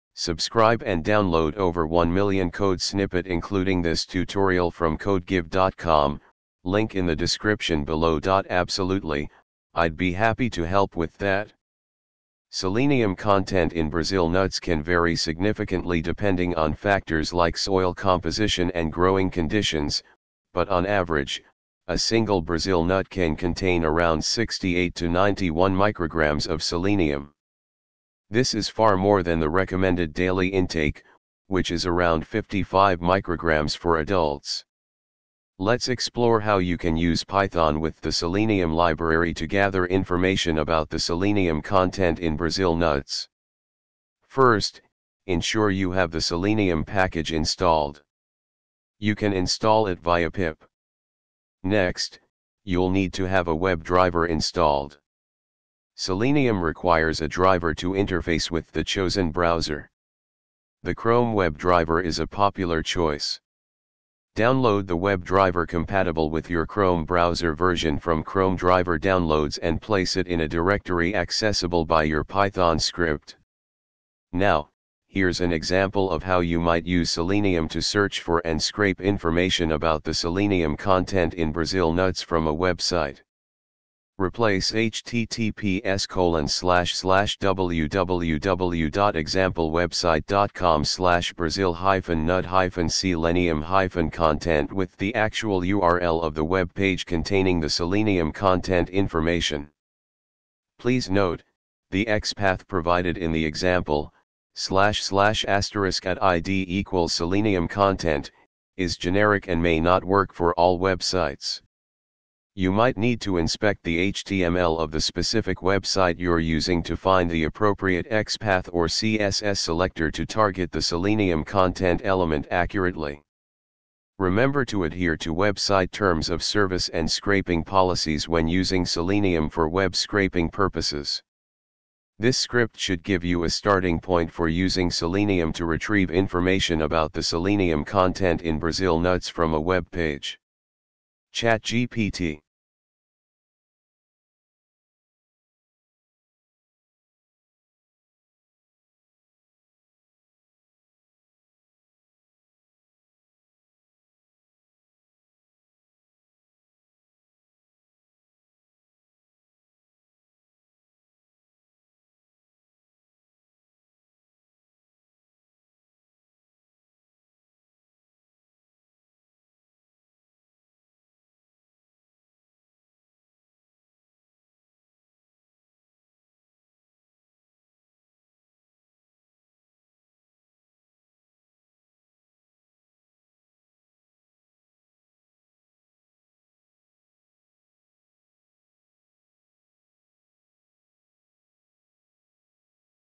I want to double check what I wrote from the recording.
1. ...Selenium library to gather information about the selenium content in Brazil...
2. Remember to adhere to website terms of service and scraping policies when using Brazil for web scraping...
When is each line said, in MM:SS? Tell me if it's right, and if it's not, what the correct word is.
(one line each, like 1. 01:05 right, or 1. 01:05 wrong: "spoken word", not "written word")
1. 00:38 right
2. 02:04 wrong: "Selenium", not "Brazil".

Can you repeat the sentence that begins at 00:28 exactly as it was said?
This is far more than the recommended daily intake, which is around 55 micrograms for adults.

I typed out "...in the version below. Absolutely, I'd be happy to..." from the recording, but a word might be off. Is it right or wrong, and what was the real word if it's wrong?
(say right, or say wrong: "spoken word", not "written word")
wrong: "description", not "version".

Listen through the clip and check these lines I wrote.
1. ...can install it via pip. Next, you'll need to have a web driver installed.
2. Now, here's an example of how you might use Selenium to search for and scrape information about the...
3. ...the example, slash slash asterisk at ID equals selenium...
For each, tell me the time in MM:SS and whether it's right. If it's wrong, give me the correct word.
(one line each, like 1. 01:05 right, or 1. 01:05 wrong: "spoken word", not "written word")
1. 00:49 right
2. 01:14 right
3. 01:43 right.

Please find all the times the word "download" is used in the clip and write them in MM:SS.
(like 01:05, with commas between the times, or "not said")
00:01, 01:04, 01:08.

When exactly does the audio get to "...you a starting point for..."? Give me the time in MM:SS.
02:13.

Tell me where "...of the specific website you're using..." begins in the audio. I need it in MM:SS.
01:54.